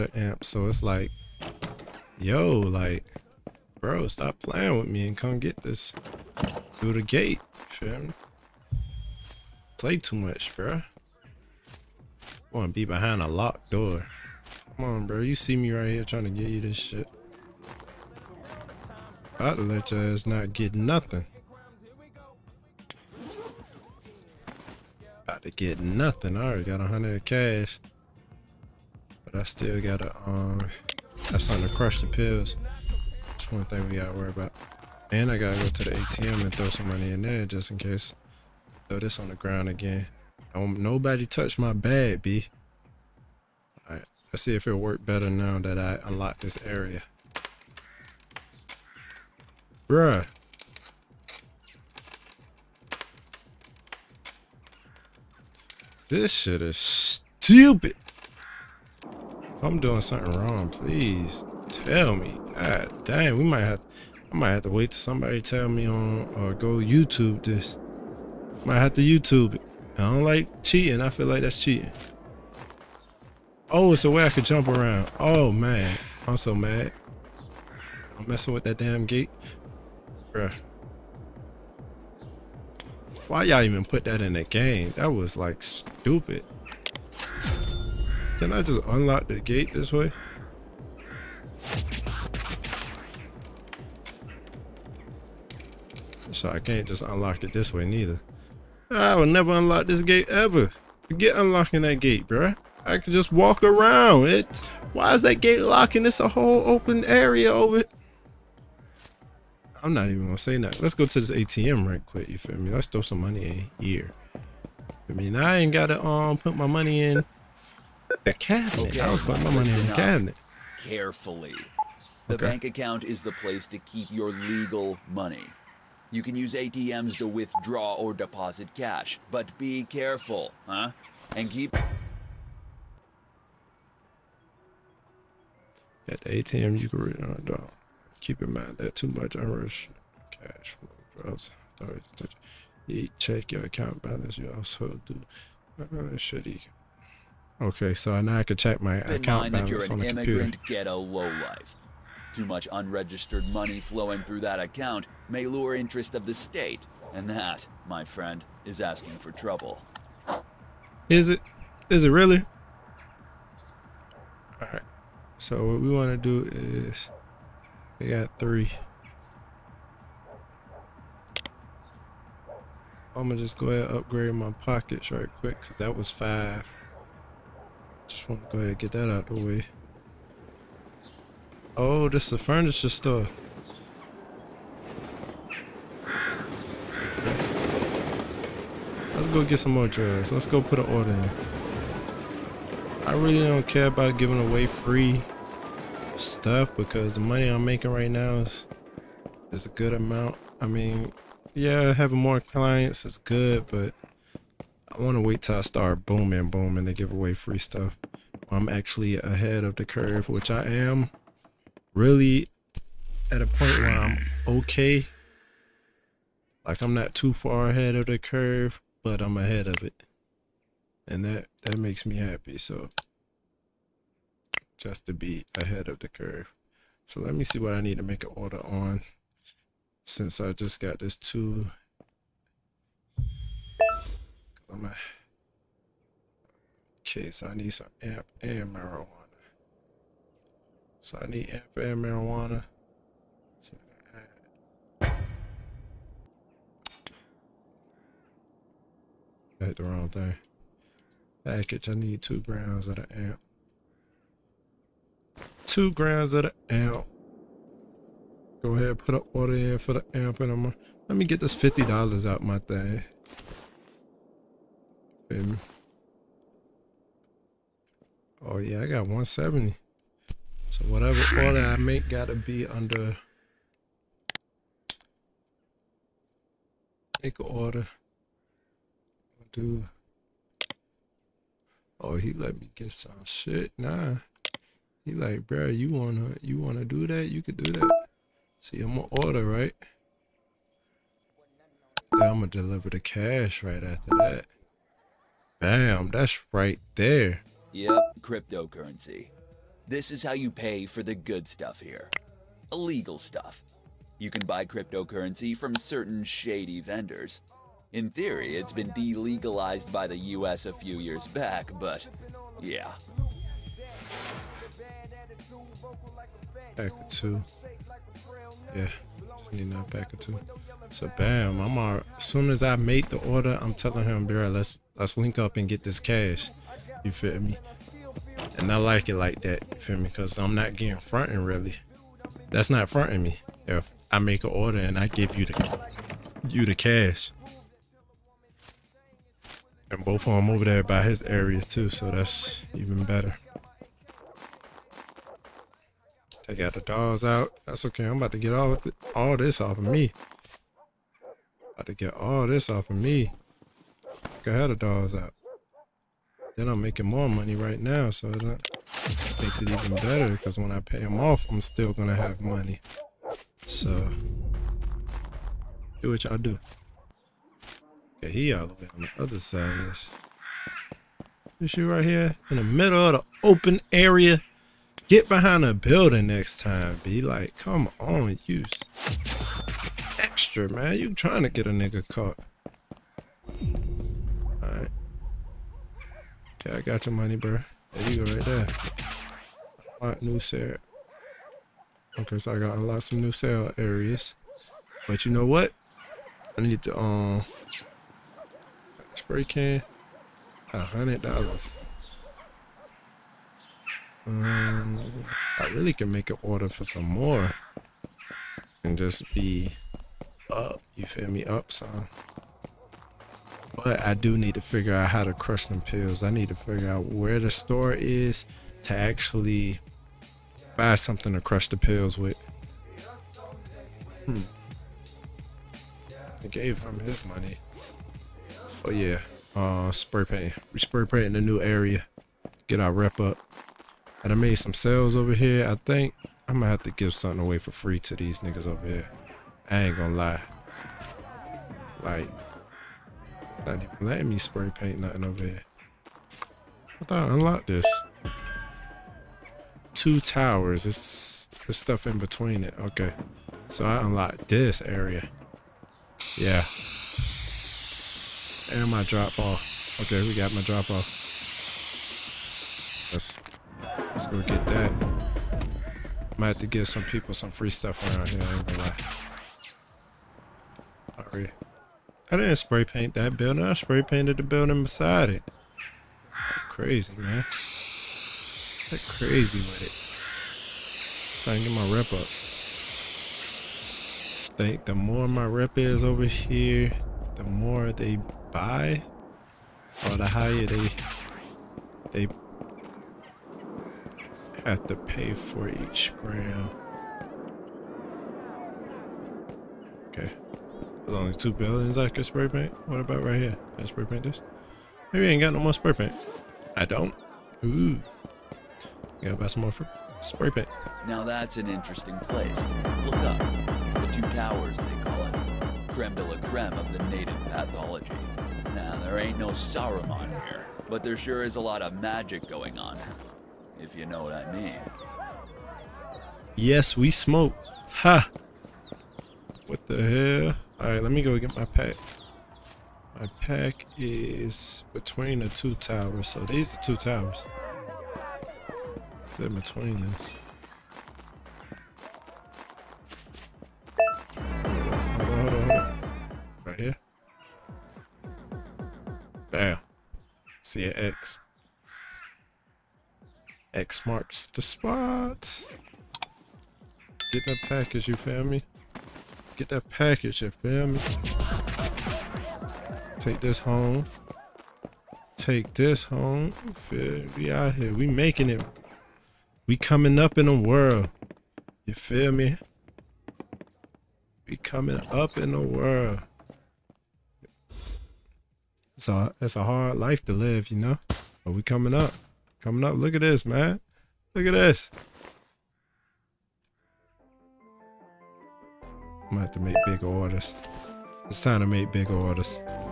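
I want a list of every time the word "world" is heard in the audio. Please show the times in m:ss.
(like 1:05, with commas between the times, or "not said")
9:30, 9:35.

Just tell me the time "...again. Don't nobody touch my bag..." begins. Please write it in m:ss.
0:39.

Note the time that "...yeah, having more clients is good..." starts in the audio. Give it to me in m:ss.
3:21.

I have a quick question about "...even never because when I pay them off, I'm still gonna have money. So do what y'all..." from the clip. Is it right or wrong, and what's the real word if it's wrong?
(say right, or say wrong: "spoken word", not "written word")
wrong: "better", not "never".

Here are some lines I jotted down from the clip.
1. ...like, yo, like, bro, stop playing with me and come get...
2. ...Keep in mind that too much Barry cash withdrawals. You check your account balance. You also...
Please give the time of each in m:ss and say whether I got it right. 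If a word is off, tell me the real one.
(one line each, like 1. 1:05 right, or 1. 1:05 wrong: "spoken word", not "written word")
1. 0:00 right
2. 2:18 wrong: "Irish", not "Barry".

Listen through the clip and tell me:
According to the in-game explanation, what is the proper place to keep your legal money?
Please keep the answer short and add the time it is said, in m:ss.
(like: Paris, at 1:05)
Bank account, at 2:02.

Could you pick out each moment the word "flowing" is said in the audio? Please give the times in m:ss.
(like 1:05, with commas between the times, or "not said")
2:33.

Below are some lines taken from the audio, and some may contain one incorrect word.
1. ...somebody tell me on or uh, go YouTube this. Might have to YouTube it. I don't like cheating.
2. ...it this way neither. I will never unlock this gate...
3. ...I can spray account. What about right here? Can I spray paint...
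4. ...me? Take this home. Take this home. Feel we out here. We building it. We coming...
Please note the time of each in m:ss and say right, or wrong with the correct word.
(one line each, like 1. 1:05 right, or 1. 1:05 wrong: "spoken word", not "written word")
1. 1:04 right
2. 1:37 right
3. 8:21 wrong: "paint", not "account"
4. 9:20 wrong: "making", not "building".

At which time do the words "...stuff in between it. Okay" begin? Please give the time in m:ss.
7:31.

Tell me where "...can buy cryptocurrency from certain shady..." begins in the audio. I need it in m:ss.
5:04.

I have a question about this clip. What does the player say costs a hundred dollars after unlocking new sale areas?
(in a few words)
Spray can.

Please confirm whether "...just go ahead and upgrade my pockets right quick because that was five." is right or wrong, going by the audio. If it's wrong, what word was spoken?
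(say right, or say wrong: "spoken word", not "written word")
right.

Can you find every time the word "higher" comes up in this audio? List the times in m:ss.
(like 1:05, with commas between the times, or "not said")
8:10.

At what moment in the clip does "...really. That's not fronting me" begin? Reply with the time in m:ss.
5:31.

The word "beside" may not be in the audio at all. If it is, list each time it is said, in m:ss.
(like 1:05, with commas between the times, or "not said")
7:54.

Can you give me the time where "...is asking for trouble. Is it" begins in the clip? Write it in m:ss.
2:38.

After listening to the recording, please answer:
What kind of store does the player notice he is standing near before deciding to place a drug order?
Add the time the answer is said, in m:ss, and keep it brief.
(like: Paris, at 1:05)
Furniture store, at 3:02.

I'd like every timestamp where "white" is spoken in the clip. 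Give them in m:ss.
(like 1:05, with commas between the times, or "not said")
not said.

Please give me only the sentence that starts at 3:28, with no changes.
I'm actually ahead of the curve, which I am really at a point where I'm okay.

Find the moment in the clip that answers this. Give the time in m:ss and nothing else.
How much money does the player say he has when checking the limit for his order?
4:29.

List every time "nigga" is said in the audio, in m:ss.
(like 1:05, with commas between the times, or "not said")
6:21, 7:18.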